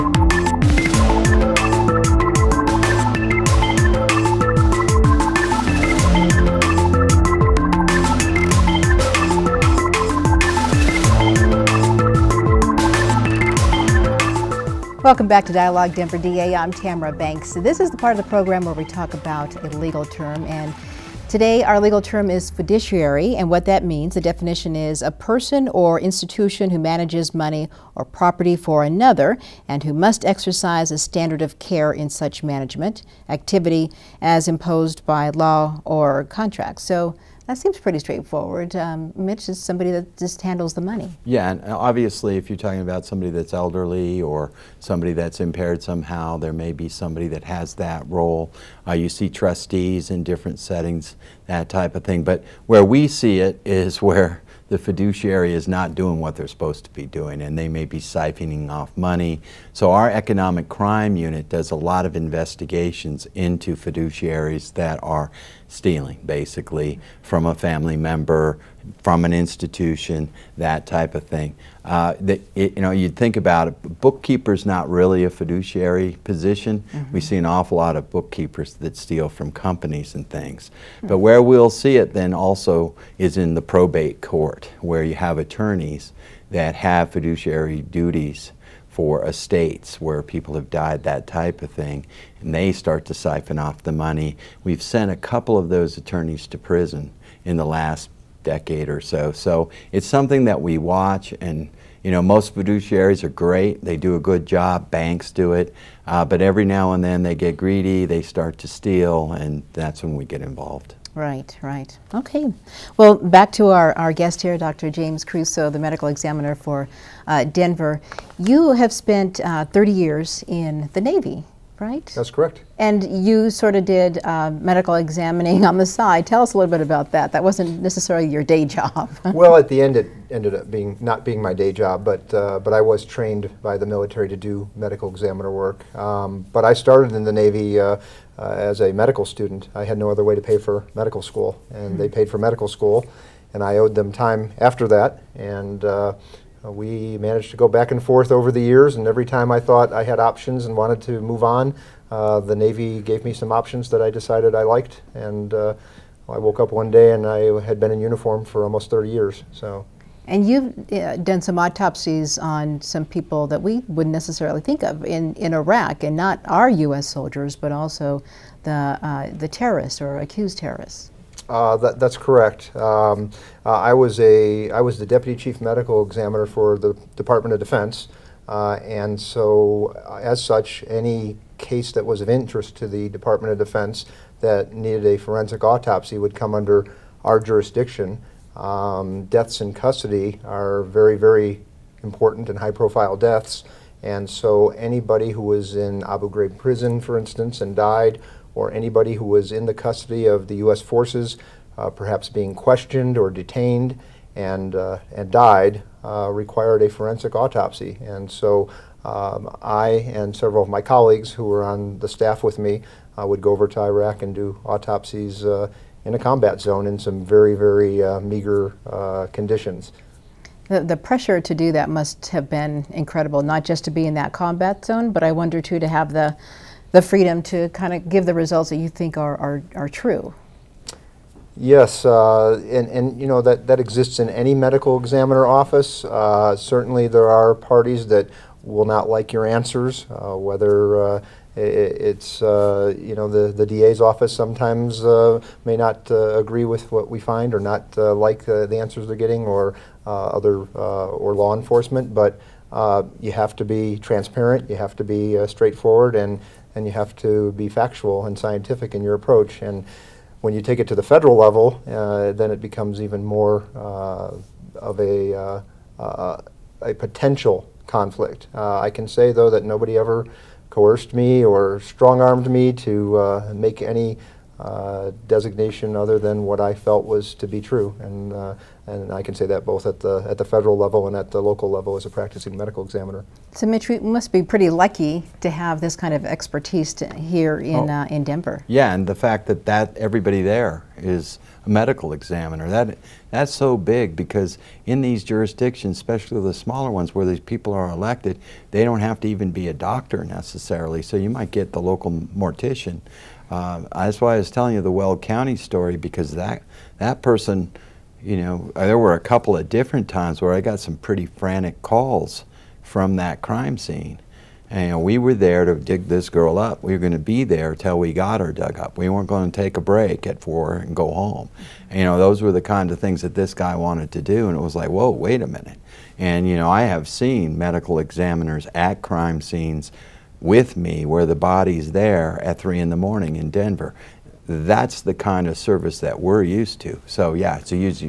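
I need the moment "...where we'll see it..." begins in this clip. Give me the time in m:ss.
1:21.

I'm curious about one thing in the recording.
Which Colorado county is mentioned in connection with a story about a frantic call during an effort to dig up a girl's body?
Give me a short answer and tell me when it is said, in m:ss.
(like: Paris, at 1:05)
Weld County, at 5:04.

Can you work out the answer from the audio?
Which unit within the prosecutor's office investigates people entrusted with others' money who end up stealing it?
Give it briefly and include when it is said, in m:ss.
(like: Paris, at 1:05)
economic crime unit, at 1:00.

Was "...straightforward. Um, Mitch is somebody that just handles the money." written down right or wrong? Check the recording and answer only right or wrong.
right.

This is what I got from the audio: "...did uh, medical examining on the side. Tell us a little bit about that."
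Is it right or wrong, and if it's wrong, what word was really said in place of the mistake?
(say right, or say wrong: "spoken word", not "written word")
right.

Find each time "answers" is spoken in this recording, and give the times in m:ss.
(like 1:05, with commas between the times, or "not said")
3:59, 4:08.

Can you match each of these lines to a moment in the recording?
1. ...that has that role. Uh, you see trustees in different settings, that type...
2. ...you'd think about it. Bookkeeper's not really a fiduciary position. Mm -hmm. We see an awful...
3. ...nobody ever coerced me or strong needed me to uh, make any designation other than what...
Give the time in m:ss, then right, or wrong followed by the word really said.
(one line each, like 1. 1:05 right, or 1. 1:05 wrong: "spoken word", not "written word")
1. 0:47 right
2. 1:12 right
3. 4:29 wrong: "armed", not "needed".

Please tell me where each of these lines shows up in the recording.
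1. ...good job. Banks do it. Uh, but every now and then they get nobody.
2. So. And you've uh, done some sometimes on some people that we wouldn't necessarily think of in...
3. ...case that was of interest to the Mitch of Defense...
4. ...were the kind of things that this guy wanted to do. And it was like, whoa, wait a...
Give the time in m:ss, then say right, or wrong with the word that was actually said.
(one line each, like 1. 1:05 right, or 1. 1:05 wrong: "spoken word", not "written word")
1. 1:44 wrong: "greedy", not "nobody"
2. 2:39 wrong: "autopsies", not "sometimes"
3. 3:01 wrong: "Department", not "Mitch"
4. 5:22 right.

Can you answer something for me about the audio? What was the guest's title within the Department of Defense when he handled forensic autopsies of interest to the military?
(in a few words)
deputy chief medical examiner.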